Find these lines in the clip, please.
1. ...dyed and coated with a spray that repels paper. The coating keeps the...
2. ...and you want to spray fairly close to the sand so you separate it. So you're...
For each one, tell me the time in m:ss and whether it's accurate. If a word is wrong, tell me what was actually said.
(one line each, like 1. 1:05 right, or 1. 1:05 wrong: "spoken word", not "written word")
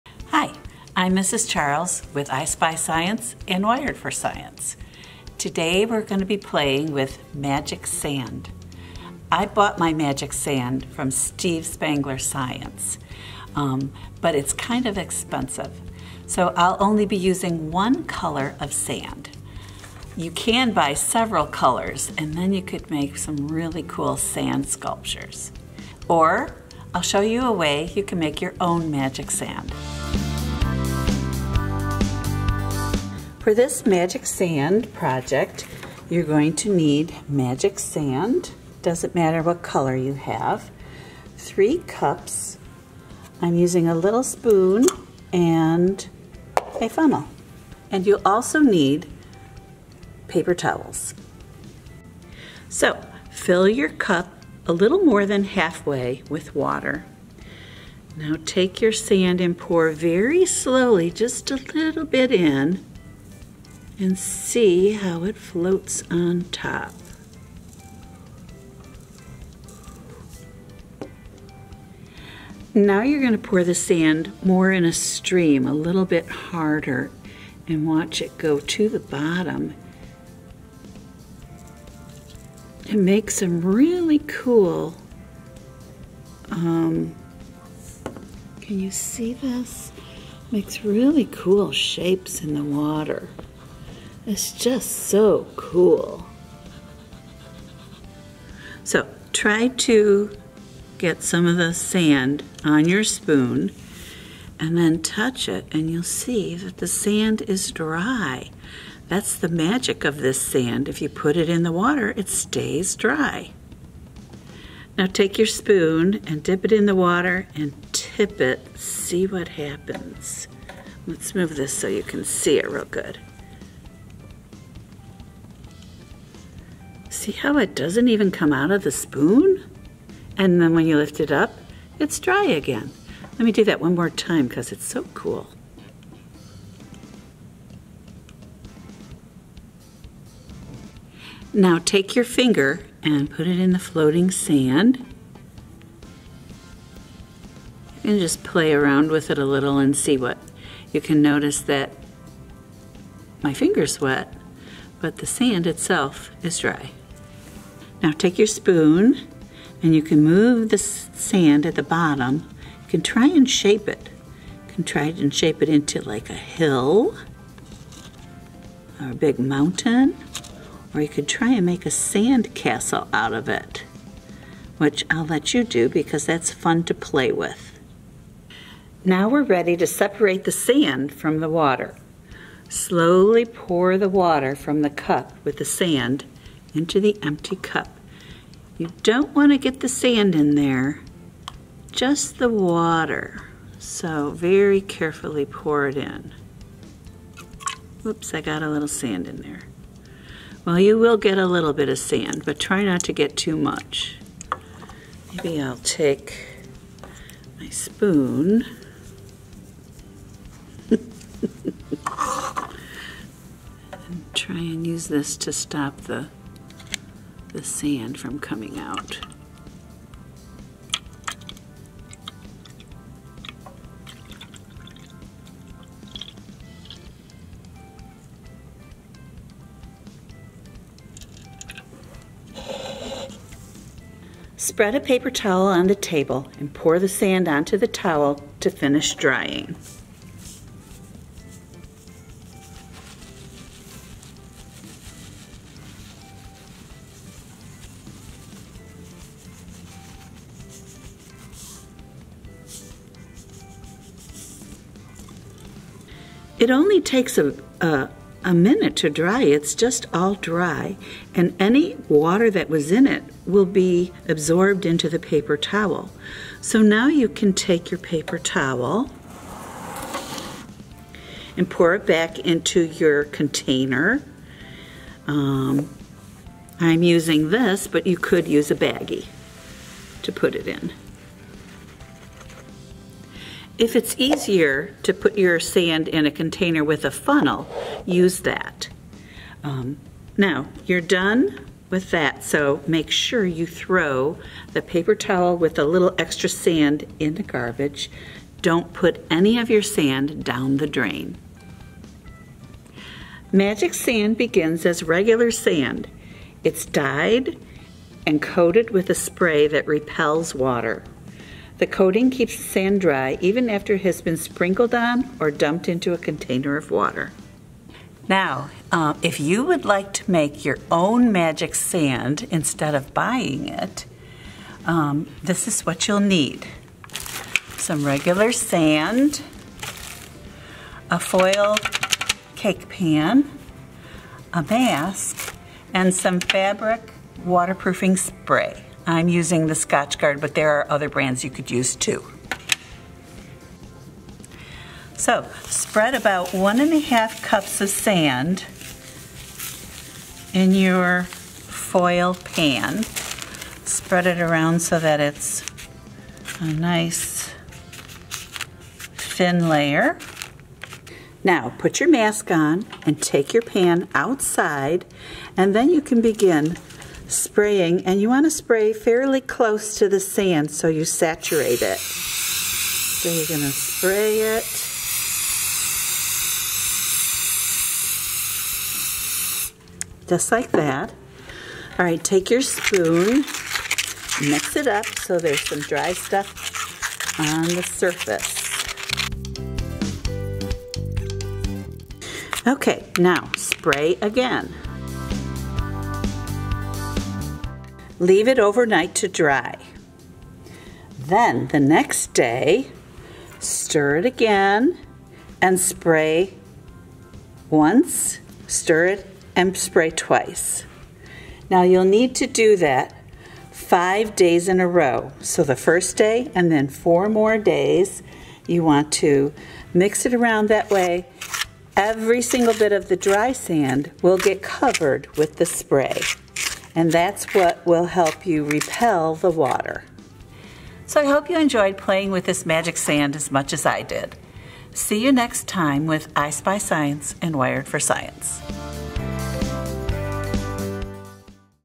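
1. 5:06 wrong: "water", not "paper"
2. 6:08 wrong: "saturate", not "separate".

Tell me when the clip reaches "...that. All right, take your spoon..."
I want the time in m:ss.
6:20.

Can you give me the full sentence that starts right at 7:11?
So I hope you enjoyed playing with this magic sand as much as I did.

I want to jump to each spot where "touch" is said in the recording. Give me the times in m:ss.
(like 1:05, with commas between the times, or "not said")
1:45.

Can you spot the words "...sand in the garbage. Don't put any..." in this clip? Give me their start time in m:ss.
4:56.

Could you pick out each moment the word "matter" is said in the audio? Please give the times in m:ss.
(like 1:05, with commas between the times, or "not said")
0:39.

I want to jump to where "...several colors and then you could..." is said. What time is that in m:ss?
0:20.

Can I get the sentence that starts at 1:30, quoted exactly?
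Makes really cool shapes in the water.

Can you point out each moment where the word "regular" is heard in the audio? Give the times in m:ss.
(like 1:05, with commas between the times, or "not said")
5:05, 5:28.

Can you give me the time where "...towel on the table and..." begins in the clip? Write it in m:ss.
3:55.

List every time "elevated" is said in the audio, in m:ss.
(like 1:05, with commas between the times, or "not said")
not said.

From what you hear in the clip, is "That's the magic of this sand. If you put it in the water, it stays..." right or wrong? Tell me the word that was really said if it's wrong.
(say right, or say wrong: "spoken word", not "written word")
right.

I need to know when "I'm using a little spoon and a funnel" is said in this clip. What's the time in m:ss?
0:43.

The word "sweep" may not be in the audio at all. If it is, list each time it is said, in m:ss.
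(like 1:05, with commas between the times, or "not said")
not said.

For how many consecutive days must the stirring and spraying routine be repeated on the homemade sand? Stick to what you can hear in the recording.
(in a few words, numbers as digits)
5.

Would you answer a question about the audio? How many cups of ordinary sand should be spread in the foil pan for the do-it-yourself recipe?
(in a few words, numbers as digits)
1.5.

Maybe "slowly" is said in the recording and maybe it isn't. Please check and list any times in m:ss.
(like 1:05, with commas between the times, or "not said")
1:00, 3:02.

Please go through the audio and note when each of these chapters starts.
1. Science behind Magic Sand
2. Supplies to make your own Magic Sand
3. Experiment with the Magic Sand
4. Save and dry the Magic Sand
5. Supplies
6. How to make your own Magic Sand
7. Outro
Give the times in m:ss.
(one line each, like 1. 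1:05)
1. 5:03
2. 5:18
3. 0:52
4. 2:58
5. 0:38
6. 5:44
7. 7:10.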